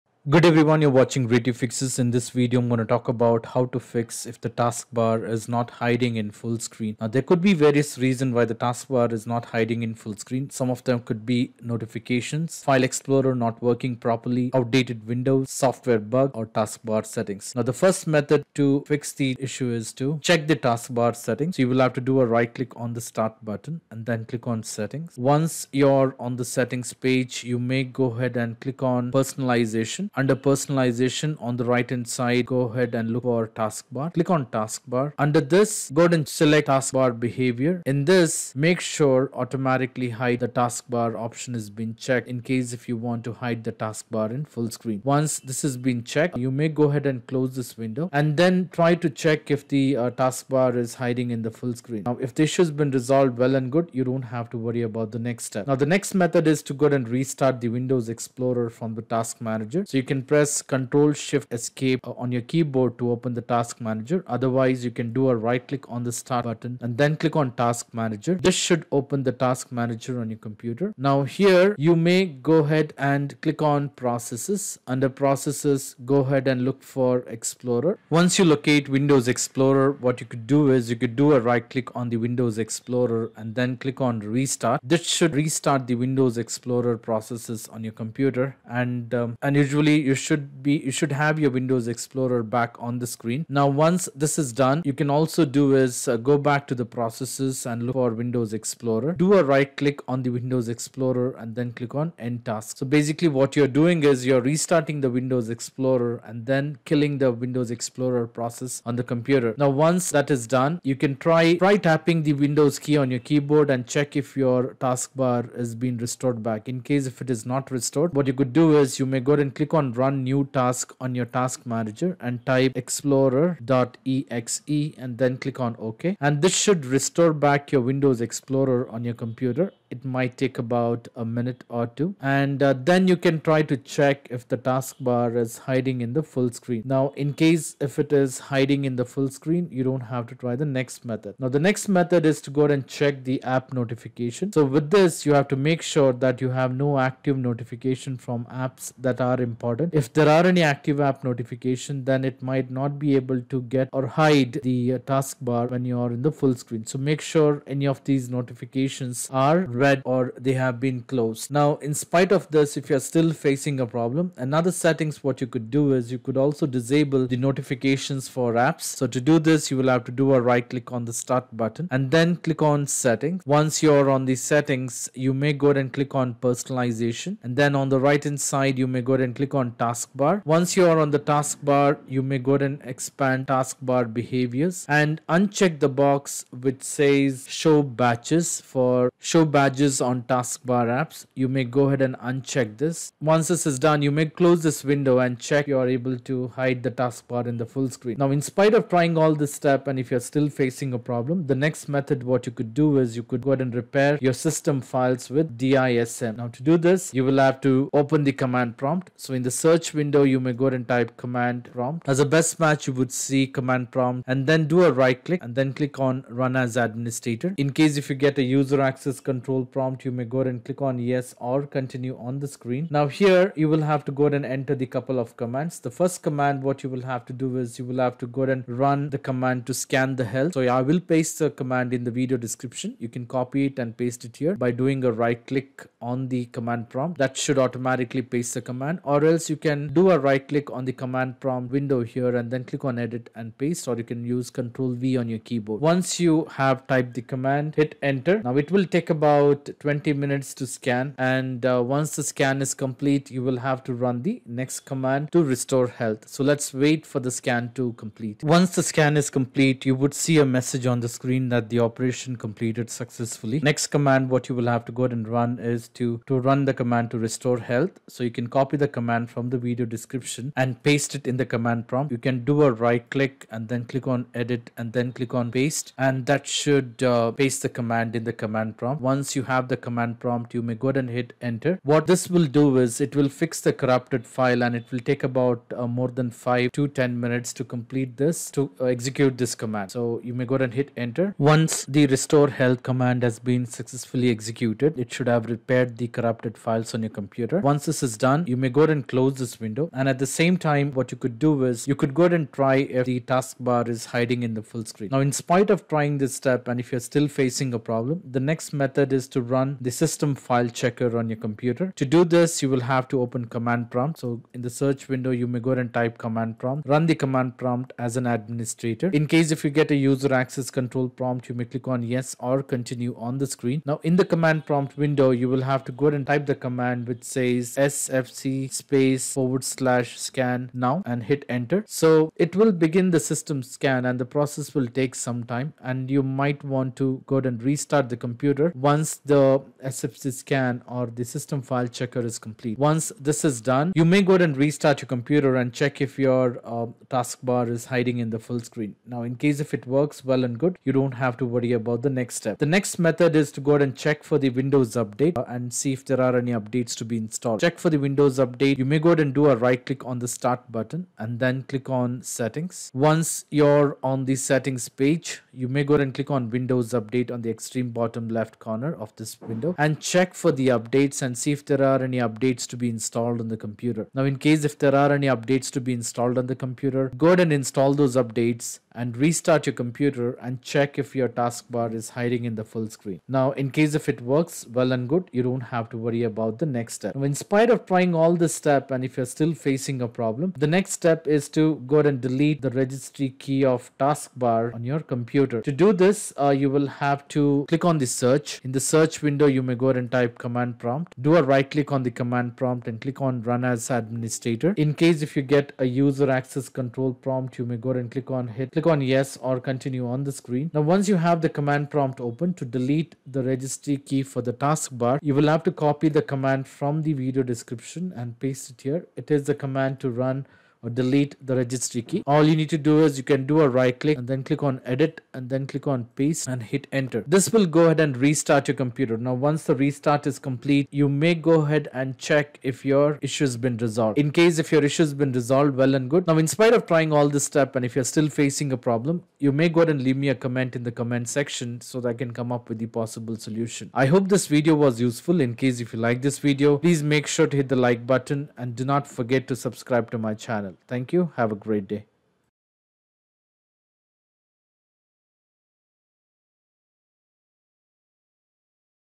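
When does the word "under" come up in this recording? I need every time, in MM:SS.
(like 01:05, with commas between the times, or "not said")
00:30, 00:35, 01:14.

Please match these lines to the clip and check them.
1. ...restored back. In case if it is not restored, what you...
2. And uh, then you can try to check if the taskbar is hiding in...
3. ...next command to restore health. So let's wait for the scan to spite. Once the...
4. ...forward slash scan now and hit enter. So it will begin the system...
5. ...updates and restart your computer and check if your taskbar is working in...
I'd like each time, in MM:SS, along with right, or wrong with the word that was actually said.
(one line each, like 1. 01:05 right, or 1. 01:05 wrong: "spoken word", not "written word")
1. 01:55 right
2. 02:12 right
3. 04:14 wrong: "complete", not "spite"
4. 05:29 right
5. 06:18 wrong: "hiding", not "working".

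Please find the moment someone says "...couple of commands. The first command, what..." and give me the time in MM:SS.
03:44.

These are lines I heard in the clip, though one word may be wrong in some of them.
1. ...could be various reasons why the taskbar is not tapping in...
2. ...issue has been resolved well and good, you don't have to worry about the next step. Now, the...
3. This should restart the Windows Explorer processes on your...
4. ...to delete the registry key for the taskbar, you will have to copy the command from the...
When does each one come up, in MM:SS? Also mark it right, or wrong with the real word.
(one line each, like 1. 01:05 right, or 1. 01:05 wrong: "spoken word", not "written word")
1. 00:07 wrong: "hiding", not "tapping"
2. 00:52 right
3. 01:24 right
4. 06:52 right.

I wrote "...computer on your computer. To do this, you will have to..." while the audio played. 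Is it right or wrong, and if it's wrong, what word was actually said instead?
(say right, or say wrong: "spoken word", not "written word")
wrong: "checker", not "computer".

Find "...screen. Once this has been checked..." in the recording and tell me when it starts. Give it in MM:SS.
00:44.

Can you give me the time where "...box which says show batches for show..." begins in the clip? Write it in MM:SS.
03:06.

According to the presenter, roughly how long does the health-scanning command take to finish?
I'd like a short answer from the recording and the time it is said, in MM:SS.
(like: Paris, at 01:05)
20 minutes, at 04:09.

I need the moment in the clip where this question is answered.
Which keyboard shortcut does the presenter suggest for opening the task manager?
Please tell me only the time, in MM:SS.
01:00.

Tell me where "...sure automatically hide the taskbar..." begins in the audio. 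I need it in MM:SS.
00:38.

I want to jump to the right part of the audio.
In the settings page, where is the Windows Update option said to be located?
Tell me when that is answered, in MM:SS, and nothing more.
06:07.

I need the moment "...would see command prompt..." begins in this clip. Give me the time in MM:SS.
03:32.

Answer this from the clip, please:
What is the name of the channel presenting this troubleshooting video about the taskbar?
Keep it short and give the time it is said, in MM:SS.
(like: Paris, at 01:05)
Ray Tube Fixes, at 00:01.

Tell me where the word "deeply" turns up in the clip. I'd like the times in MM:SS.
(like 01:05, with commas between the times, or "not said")
not said.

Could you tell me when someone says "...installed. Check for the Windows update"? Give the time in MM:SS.
05:57.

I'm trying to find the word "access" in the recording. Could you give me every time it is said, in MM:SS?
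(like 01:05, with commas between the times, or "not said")
03:38, 05:20, 06:46.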